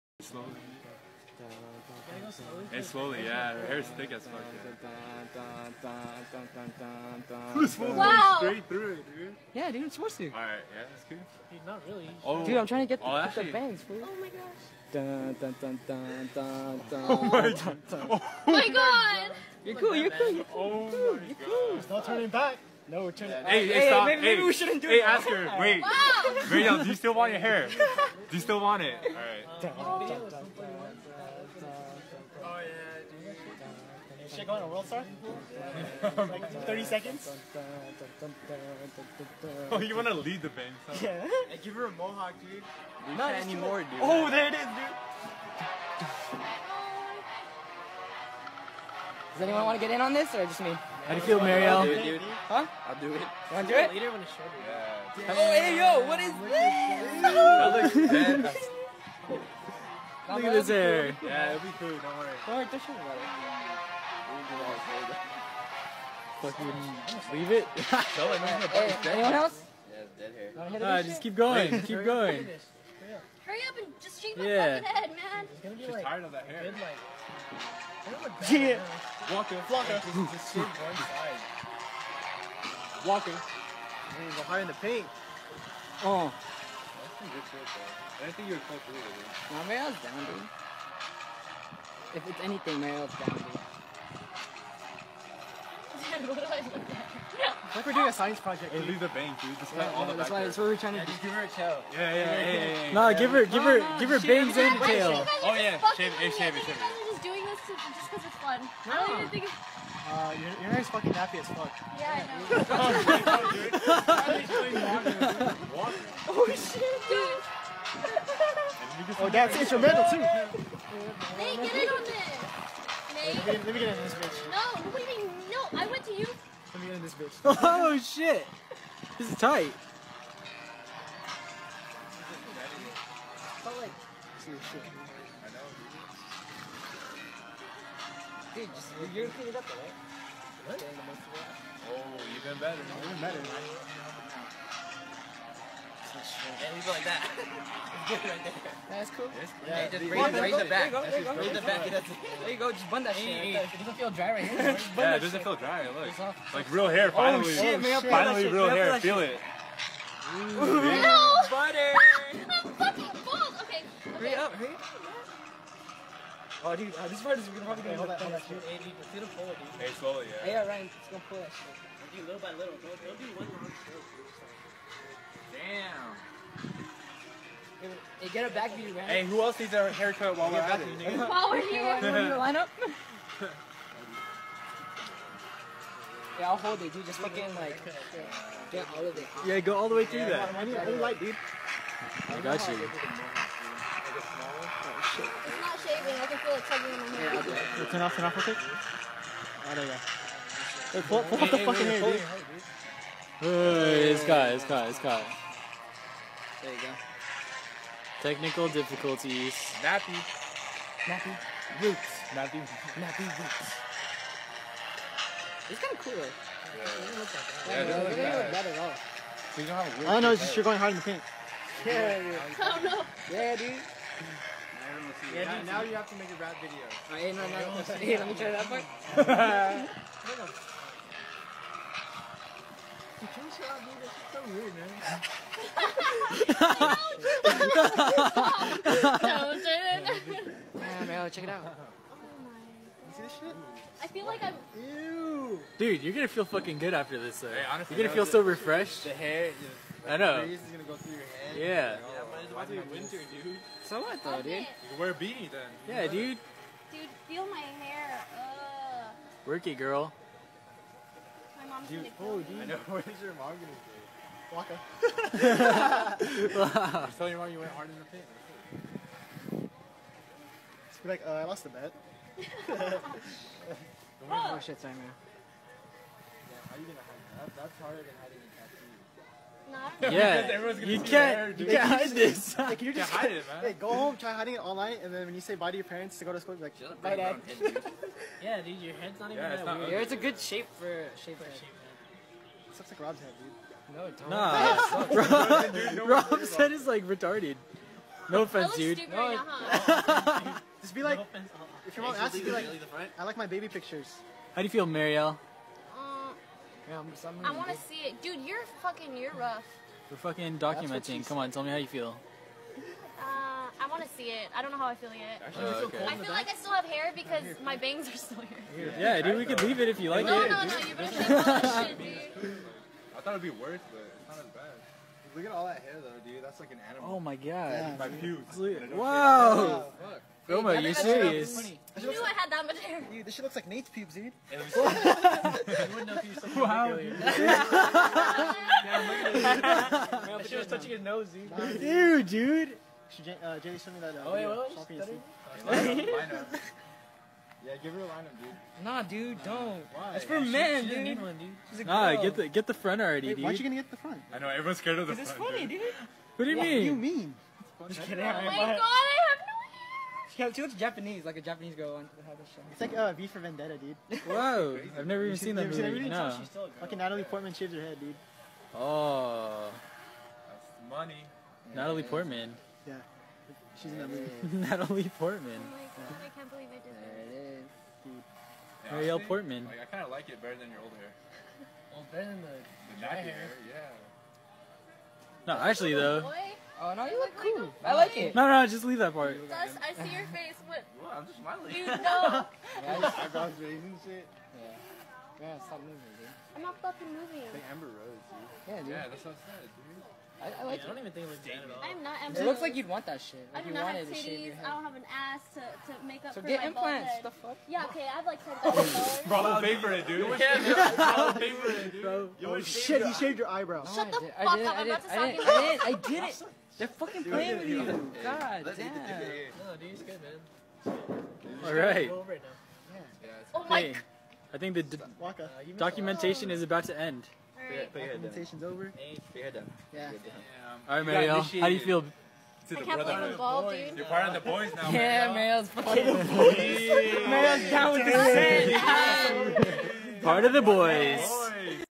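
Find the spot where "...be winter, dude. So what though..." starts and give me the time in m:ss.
4:12.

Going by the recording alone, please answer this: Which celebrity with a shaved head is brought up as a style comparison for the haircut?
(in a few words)
Amber Rose.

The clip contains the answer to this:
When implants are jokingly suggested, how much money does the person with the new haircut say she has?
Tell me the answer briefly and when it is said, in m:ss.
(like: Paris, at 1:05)
$10, at 6:48.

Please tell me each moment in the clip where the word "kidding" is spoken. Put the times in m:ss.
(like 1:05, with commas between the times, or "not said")
5:58.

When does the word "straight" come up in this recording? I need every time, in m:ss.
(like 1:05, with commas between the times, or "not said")
0:08.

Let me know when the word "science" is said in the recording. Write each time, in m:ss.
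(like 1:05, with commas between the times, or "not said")
1:38.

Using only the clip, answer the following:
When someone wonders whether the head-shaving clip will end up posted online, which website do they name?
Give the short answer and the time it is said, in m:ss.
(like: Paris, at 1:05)
World Star, at 0:34.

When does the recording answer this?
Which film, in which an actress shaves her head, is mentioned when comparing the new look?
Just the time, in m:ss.
6:03.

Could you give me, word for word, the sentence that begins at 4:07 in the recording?
Hey, honestly, you're gonna feel so refreshed.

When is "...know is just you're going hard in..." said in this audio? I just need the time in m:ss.
3:40.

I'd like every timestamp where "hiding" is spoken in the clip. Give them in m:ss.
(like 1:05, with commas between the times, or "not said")
4:38, 4:44.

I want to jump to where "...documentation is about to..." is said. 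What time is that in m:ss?
7:05.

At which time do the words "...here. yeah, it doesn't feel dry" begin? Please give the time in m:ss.
2:34.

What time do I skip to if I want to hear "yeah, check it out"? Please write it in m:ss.
4:01.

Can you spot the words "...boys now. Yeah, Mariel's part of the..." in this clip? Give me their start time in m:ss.
7:14.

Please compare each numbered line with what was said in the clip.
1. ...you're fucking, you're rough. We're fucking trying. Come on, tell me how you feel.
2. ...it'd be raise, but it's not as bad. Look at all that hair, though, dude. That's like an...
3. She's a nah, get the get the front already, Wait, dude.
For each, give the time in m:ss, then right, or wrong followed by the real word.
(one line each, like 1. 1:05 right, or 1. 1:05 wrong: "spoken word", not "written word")
1. 5:08 wrong: "documenting", not "trying"
2. 5:23 wrong: "worse", not "raise"
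3. 5:51 right.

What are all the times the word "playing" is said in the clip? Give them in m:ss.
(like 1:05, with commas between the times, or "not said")
6:57.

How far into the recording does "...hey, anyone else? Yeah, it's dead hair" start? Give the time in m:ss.
1:07.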